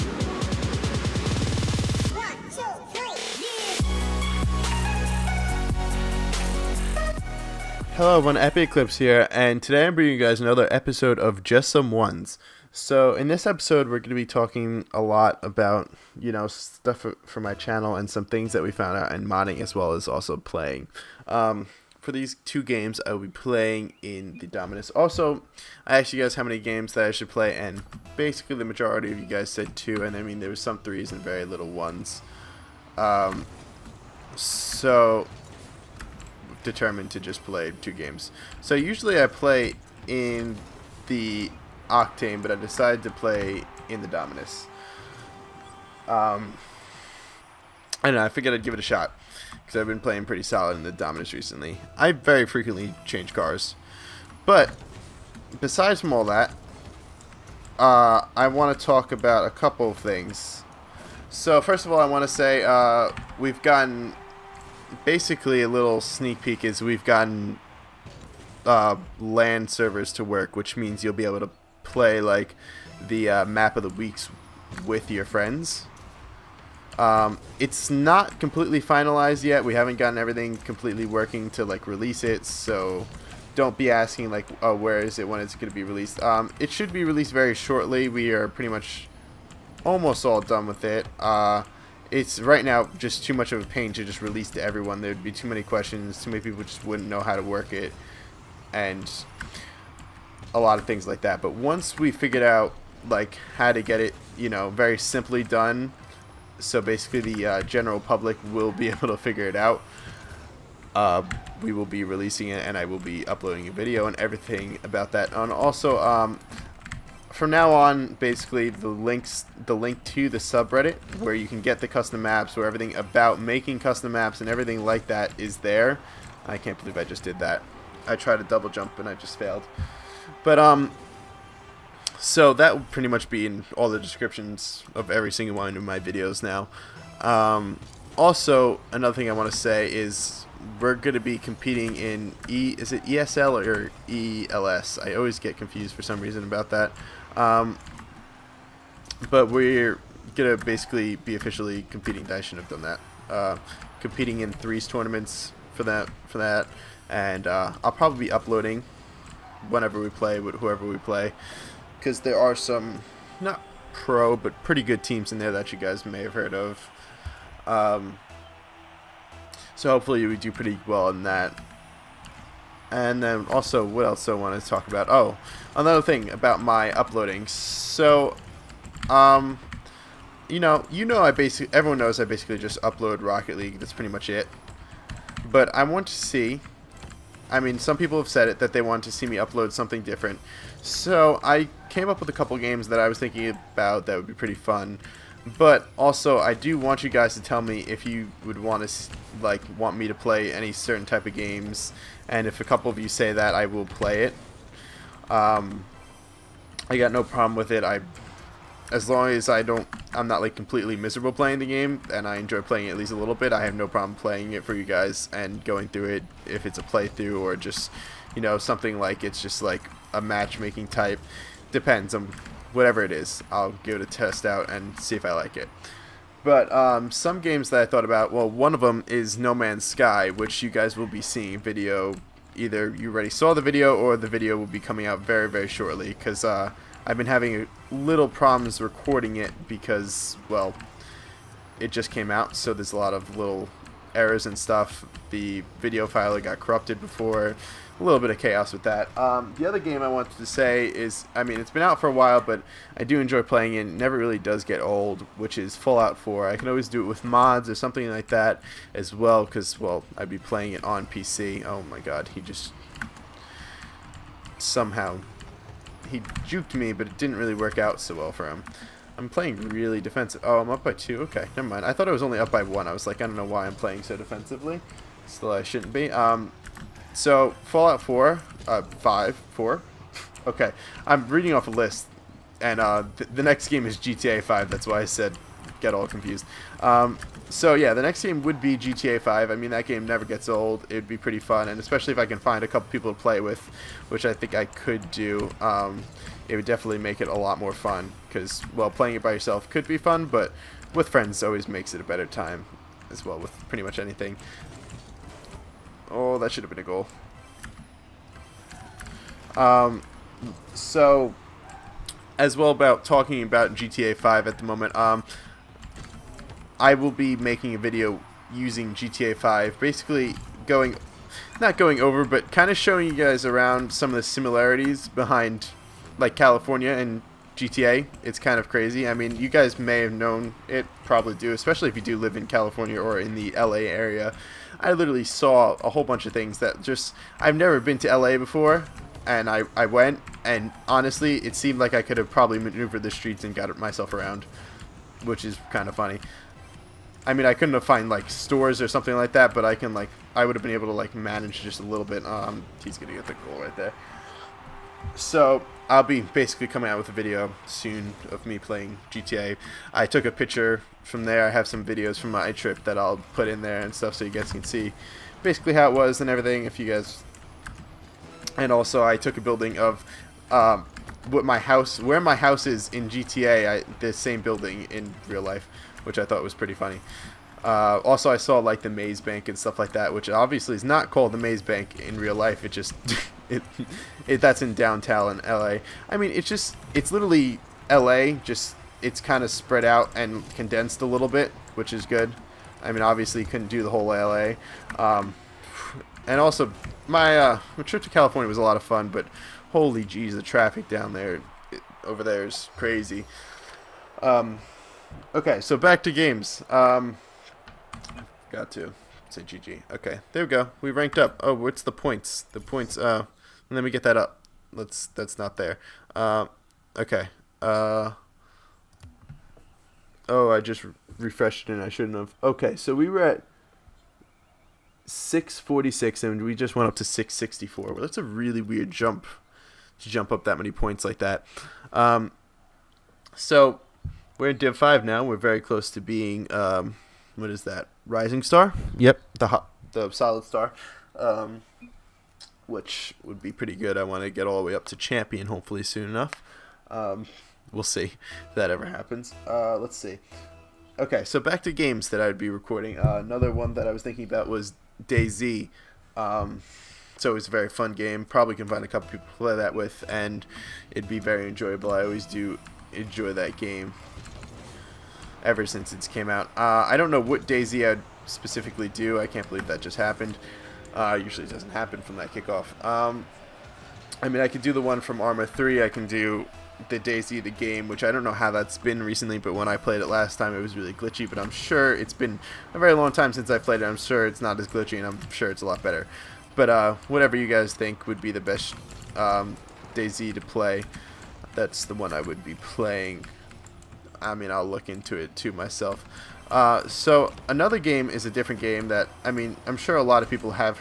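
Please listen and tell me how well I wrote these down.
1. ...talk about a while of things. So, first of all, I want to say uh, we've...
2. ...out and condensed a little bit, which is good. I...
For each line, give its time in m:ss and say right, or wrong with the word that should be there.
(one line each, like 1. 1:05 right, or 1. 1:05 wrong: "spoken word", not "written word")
1. 0:58 wrong: "couple", not "while"
2. 6:29 right.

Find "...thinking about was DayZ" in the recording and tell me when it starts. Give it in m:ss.
7:34.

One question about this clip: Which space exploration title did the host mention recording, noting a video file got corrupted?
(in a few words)
No Man's Sky.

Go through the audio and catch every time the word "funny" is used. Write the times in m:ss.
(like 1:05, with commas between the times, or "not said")
5:45, 6:16.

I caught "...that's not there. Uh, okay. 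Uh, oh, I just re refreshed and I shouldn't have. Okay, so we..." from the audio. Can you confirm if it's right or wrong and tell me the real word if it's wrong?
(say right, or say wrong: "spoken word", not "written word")
right.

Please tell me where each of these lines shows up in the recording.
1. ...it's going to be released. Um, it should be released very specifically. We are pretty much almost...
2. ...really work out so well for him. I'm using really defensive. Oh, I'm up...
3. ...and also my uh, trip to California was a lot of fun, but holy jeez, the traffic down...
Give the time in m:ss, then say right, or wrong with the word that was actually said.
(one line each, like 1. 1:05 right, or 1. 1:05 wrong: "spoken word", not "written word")
1. 1:25 wrong: "shortly", not "specifically"
2. 4:27 wrong: "playing", not "using"
3. 6:36 right.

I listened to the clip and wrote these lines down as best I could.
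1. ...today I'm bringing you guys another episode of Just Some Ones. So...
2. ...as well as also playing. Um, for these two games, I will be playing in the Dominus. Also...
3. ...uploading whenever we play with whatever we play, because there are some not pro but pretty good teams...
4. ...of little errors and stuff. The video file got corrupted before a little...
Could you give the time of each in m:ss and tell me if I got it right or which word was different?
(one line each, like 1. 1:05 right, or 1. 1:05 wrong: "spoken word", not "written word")
1. 0:09 right
2. 0:19 right
3. 2:38 wrong: "whoever", not "whatever"
4. 4:03 right.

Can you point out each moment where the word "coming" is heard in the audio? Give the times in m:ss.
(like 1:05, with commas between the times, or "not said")
3:54, 5:56.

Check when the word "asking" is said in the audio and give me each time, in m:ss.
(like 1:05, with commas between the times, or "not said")
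1:23.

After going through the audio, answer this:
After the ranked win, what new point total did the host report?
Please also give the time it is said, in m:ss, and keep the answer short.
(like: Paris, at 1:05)
664, at 7:07.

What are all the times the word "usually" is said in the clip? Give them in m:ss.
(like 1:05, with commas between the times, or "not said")
0:38, 7:51.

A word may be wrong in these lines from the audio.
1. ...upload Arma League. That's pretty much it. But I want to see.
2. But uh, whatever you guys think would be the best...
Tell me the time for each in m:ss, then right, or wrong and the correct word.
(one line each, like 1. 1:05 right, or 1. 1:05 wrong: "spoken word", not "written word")
1. 3:02 wrong: "Rocket", not "Arma"
2. 8:06 right.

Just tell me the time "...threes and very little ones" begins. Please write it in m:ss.
0:30.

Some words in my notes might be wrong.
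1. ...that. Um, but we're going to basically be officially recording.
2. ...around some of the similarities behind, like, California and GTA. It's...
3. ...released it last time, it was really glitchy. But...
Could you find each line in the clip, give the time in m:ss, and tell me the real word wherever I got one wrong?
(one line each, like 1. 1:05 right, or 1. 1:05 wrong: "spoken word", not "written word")
1. 2:26 wrong: "competing", not "recording"
2. 5:23 right
3. 7:59 wrong: "played", not "released".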